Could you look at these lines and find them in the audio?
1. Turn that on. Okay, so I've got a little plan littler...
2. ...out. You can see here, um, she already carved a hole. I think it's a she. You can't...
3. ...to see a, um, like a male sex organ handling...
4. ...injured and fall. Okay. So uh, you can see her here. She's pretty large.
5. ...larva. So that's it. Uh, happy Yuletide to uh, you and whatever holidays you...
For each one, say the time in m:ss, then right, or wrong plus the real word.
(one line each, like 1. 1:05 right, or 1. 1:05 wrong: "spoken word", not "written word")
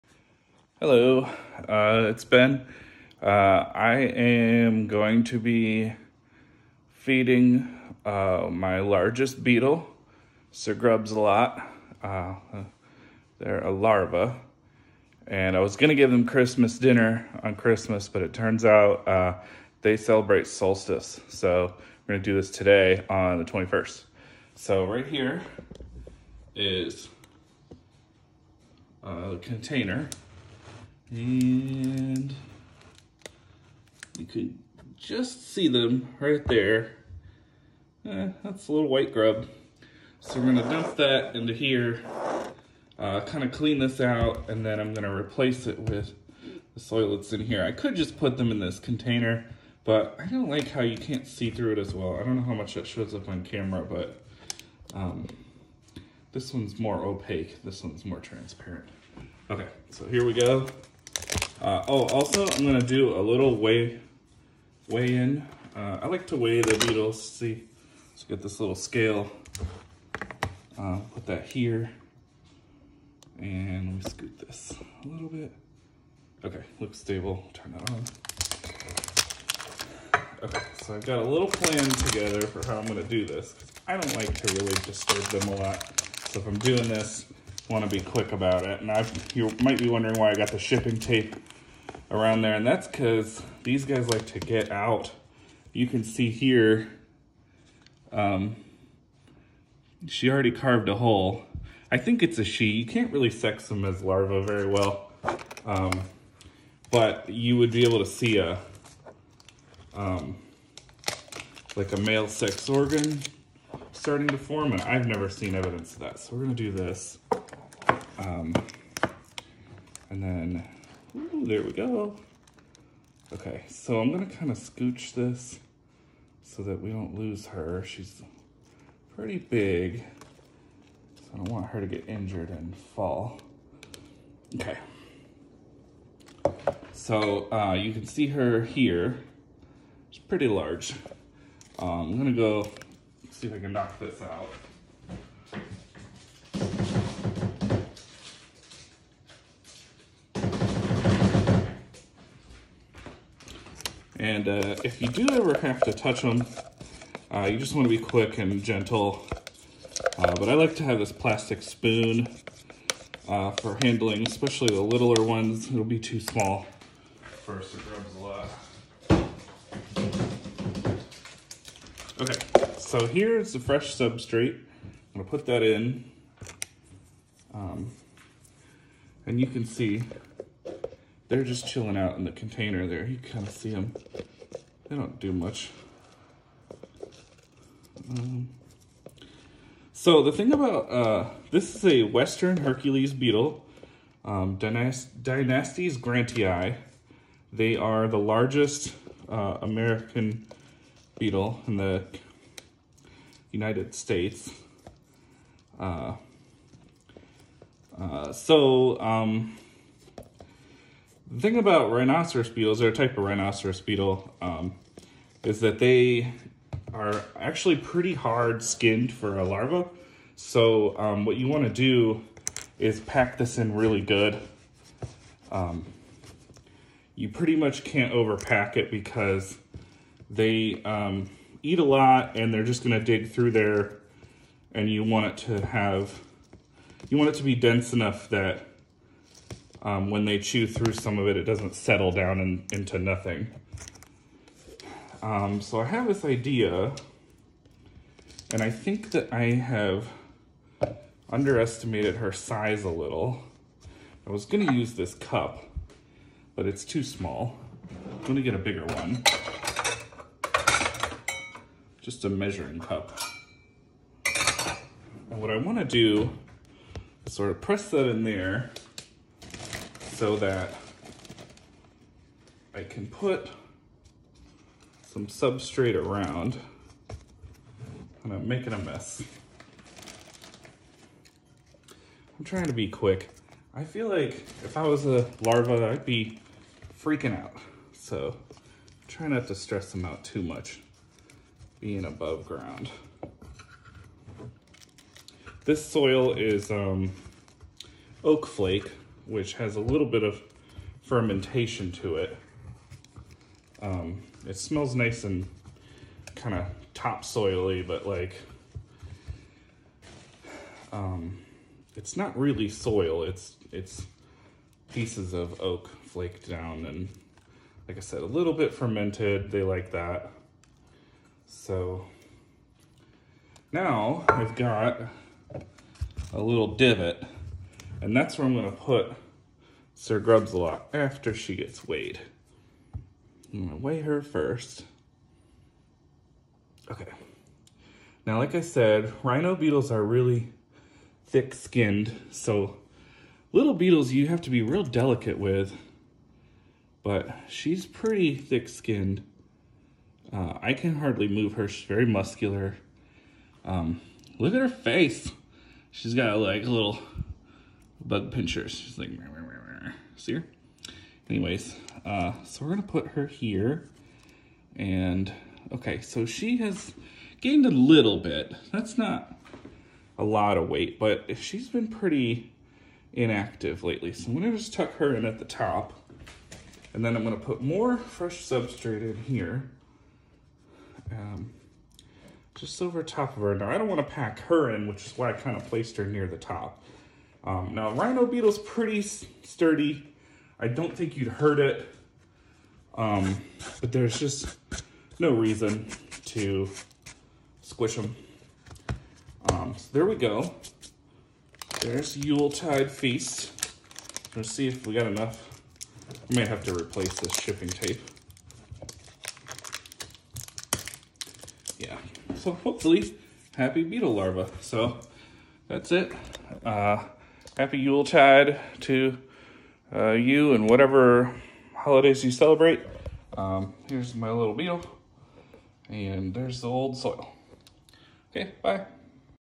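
1. 1:17 wrong: "together", not "littler"
2. 1:34 right
3. 1:47 wrong: "starting", not "handling"
4. 2:12 right
5. 6:54 right.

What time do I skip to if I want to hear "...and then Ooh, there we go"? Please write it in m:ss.
2:00.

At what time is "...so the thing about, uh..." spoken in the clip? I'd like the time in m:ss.
3:09.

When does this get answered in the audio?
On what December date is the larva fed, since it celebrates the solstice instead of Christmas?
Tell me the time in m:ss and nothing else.
0:23.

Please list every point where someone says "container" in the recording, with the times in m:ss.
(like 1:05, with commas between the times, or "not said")
0:29, 0:48, 3:02.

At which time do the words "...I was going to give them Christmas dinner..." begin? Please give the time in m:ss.
0:15.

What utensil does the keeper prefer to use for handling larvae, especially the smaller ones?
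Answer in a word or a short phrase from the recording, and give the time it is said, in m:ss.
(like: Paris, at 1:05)
Plastic spoon, at 2:41.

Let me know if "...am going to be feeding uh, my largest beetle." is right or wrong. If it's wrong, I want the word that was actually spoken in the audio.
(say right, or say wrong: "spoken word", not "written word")
right.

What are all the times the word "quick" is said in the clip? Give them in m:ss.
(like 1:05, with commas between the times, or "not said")
1:28, 2:37, 4:42.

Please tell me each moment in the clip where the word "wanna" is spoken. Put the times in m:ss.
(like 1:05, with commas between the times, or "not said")
4:25, 6:23.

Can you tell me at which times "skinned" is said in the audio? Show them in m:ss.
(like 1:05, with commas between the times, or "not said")
3:38, 5:41, 5:48.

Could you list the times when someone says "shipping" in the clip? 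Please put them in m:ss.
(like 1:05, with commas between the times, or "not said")
1:30, 6:47.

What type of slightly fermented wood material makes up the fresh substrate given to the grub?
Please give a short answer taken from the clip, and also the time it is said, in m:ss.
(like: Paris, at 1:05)
Oak flake, at 4:58.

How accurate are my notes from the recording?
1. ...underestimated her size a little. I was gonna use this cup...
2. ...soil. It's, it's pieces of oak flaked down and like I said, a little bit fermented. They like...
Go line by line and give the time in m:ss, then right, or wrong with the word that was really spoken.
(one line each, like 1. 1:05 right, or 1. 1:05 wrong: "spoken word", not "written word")
1. 4:11 right
2. 5:12 right.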